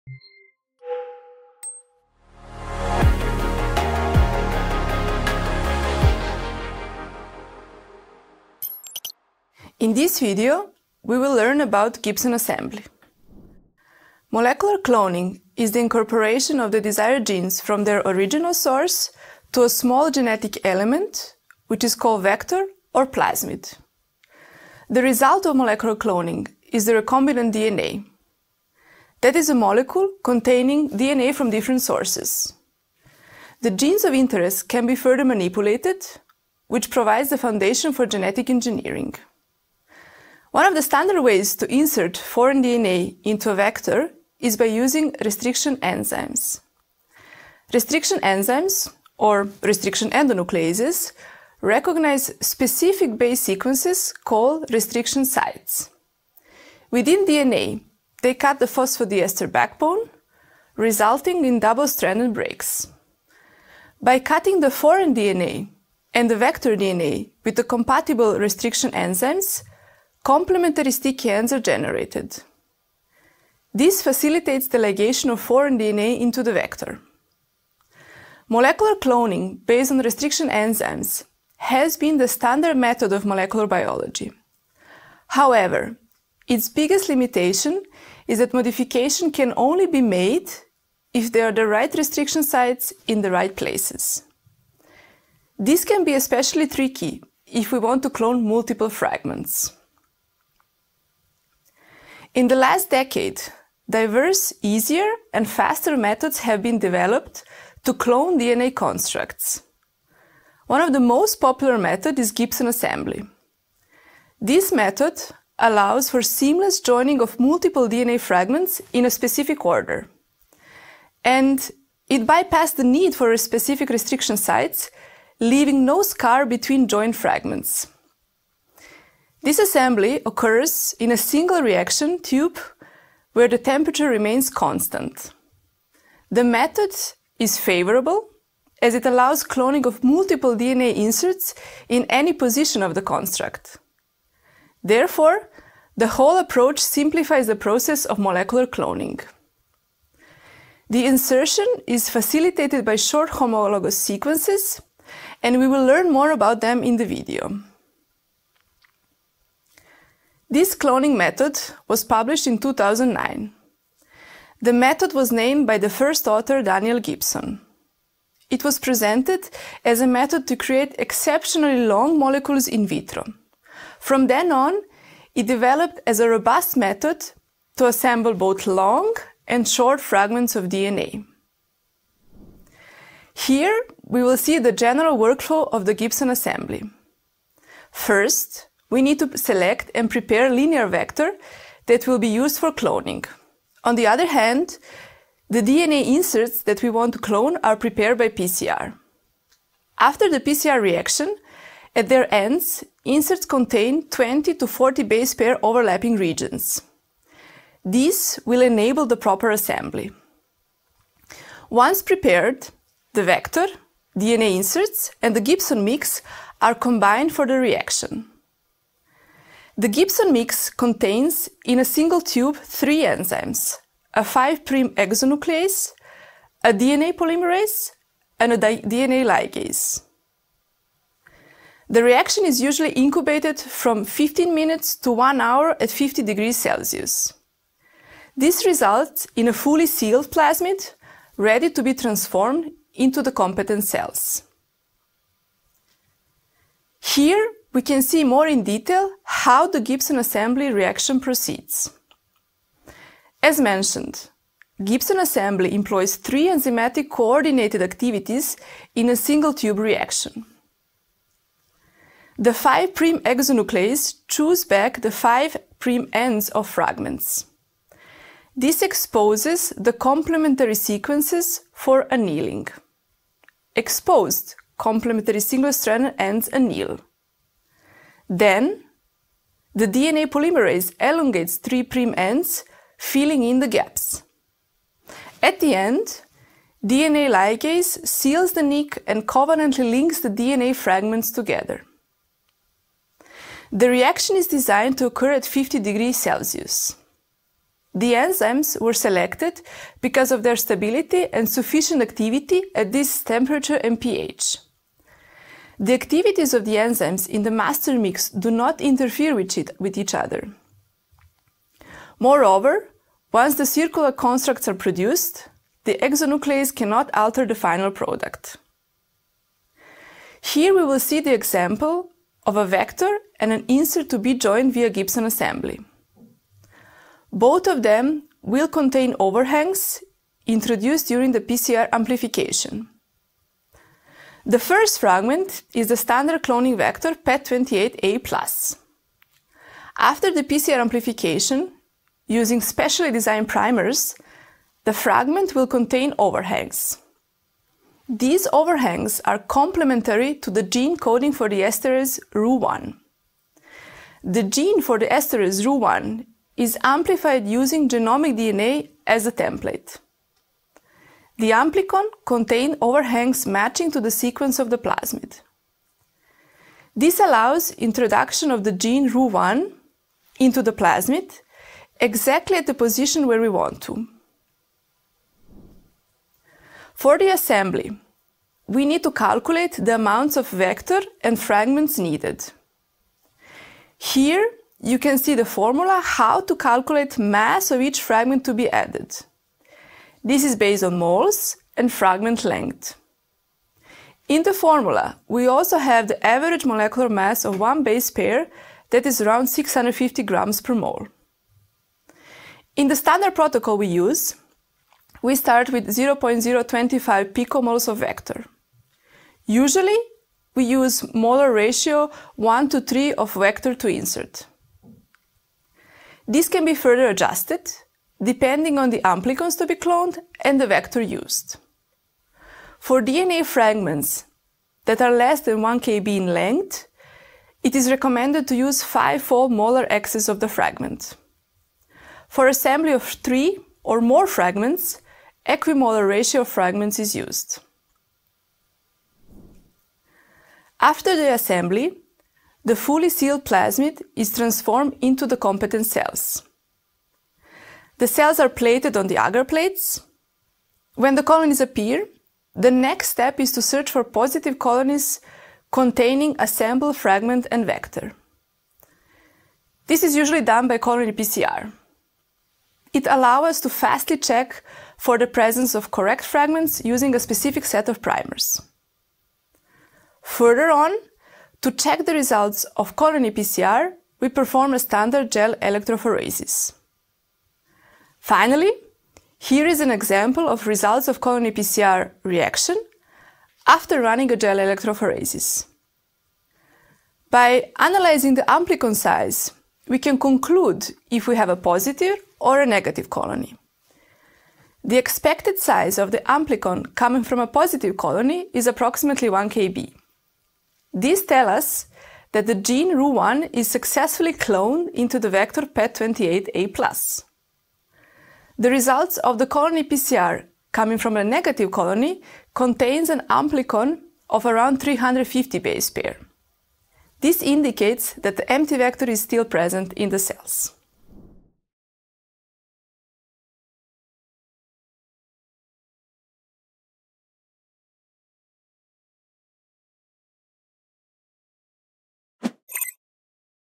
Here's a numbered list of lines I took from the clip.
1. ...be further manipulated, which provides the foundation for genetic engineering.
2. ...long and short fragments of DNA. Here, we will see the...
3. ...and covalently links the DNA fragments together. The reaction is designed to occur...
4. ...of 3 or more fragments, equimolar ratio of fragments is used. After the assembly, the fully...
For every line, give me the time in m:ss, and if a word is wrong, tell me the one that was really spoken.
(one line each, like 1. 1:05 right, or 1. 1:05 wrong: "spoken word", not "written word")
1. 0:34 right
2. 2:58 right
3. 4:49 right
4. 7:12 right.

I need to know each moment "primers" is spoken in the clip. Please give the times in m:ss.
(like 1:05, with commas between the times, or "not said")
5:43, 7:48.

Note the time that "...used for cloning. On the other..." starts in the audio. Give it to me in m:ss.
3:12.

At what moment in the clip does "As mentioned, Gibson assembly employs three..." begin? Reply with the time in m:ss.
4:13.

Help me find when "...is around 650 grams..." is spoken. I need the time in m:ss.
6:39.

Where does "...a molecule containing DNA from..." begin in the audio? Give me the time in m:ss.
0:29.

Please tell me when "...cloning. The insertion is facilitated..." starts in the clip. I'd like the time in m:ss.
2:28.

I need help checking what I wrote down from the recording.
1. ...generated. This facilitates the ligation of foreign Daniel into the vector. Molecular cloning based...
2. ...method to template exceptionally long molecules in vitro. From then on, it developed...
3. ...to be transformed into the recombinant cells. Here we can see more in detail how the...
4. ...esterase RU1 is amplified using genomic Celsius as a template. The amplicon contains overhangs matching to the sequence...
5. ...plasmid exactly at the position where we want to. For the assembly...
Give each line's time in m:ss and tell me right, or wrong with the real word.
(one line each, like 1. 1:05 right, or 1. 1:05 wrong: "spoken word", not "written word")
1. 1:11 wrong: "DNA", not "Daniel"
2. 2:50 wrong: "create", not "template"
3. 4:01 wrong: "competent", not "recombinant"
4. 5:55 wrong: "DNA", not "Celsius"
5. 6:10 right.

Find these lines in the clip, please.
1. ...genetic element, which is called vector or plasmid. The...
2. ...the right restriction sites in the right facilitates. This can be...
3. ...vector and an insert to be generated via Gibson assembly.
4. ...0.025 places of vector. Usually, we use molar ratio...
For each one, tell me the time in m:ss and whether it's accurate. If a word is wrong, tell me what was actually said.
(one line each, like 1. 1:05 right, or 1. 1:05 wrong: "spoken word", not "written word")
1. 0:20 right
2. 1:31 wrong: "places", not "facilitates"
3. 5:22 wrong: "joined", not "generated"
4. 6:45 wrong: "picomoles", not "places".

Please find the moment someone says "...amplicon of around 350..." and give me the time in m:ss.
8:33.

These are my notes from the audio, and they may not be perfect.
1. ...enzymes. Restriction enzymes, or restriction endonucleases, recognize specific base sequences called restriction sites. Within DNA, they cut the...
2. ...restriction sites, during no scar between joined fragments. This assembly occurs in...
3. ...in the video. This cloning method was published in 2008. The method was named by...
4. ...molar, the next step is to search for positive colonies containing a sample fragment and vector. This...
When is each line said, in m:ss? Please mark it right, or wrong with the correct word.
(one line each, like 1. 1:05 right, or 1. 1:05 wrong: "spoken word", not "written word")
1. 0:45 right
2. 2:03 wrong: "leaving", not "during"
3. 2:36 wrong: "2009", not "2008"
4. 7:31 wrong: "appear", not "molar".